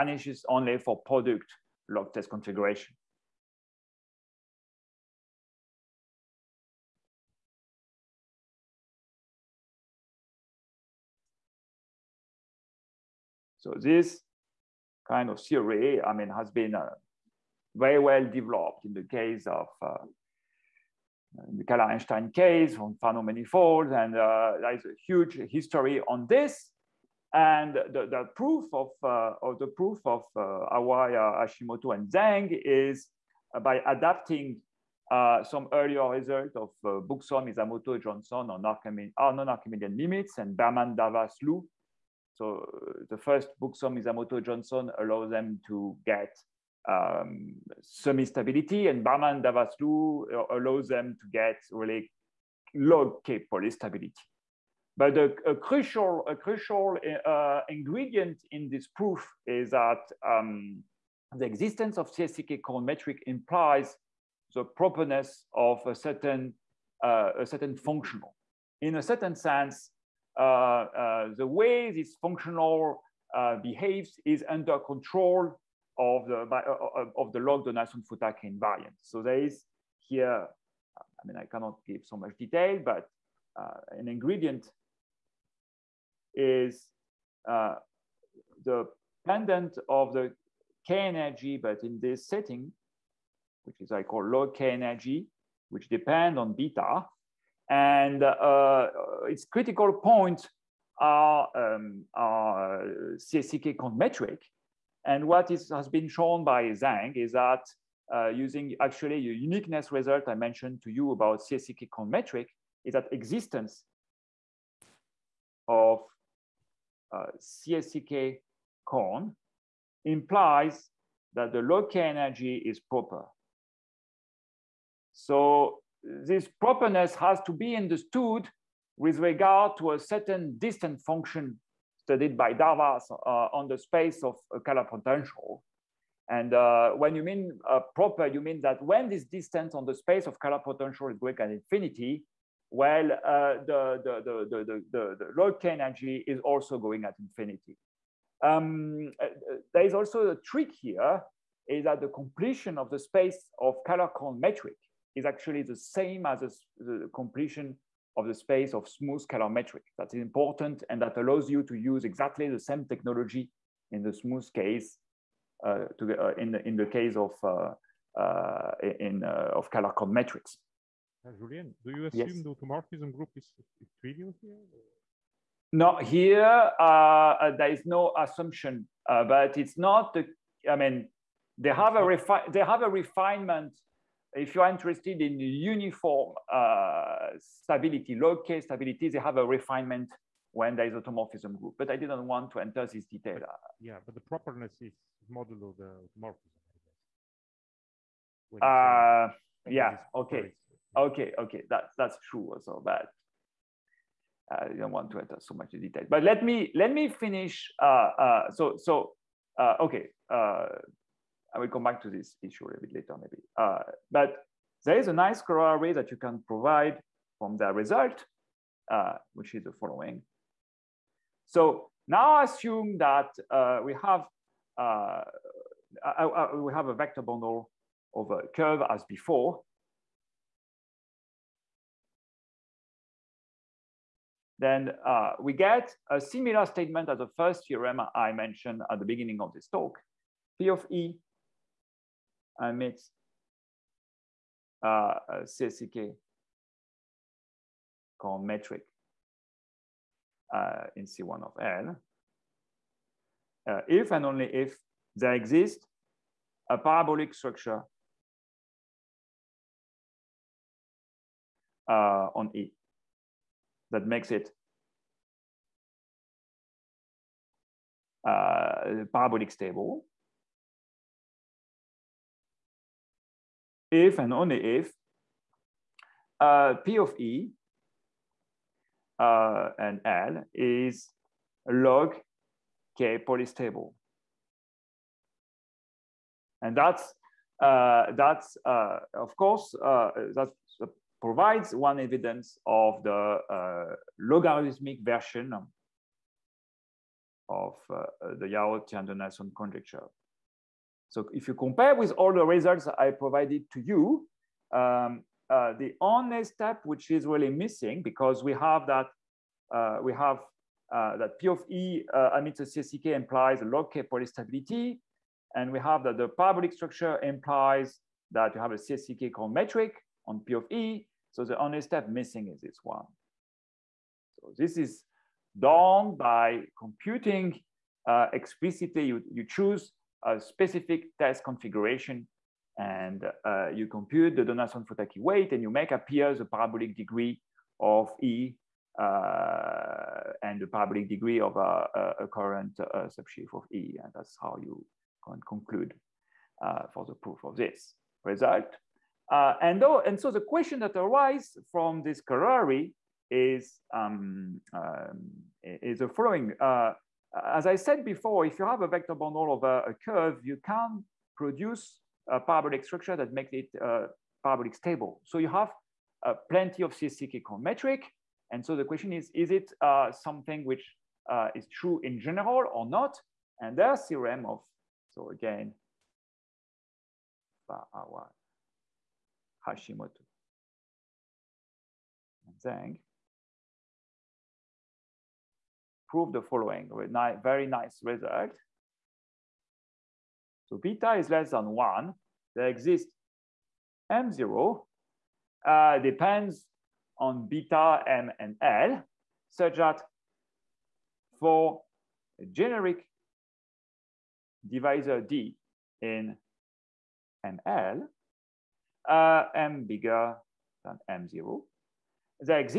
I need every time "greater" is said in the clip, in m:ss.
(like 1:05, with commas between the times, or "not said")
2:21.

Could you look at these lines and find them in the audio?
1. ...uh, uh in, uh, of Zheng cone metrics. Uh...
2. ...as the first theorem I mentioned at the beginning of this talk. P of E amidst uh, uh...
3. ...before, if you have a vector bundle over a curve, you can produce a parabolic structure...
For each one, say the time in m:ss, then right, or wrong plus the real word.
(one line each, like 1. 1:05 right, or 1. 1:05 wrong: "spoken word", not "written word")
1. 2:47 wrong: "Kähler", not "Zheng"
2. 3:57 right
3. 5:58 right.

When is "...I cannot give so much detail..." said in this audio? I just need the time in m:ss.
1:21.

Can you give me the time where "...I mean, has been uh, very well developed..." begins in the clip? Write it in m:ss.
0:16.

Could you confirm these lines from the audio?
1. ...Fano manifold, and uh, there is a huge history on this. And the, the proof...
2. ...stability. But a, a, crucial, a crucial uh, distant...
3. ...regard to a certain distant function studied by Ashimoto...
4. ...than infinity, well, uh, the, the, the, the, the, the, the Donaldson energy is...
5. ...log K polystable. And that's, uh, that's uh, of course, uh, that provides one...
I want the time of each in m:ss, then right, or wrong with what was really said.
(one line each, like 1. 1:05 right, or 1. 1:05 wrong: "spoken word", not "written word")
1. 0:22 right
2. 0:53 wrong: "ingredient", not "distant"
3. 2:09 wrong: "Darvas", not "Ashimoto"
4. 2:21 wrong: "Lorentz", not "Donaldson"
5. 4:41 right.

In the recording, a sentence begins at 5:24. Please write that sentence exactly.
So this is done by computing uh, explicitly.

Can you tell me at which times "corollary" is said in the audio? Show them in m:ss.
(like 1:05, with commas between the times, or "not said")
3:35, 5:52.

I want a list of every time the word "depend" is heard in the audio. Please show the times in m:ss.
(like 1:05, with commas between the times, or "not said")
1:35, 6:35.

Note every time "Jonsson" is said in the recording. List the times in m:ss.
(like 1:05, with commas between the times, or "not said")
0:38, 0:44.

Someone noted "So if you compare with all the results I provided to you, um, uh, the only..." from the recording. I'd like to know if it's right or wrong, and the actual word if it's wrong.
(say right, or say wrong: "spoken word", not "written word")
right.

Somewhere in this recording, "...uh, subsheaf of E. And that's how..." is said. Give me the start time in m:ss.
5:42.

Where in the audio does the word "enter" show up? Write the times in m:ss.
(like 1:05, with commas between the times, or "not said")
3:12, 3:25.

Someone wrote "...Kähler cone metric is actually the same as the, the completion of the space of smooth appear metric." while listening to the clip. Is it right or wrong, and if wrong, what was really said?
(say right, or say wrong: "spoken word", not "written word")
wrong: "scalar", not "appear".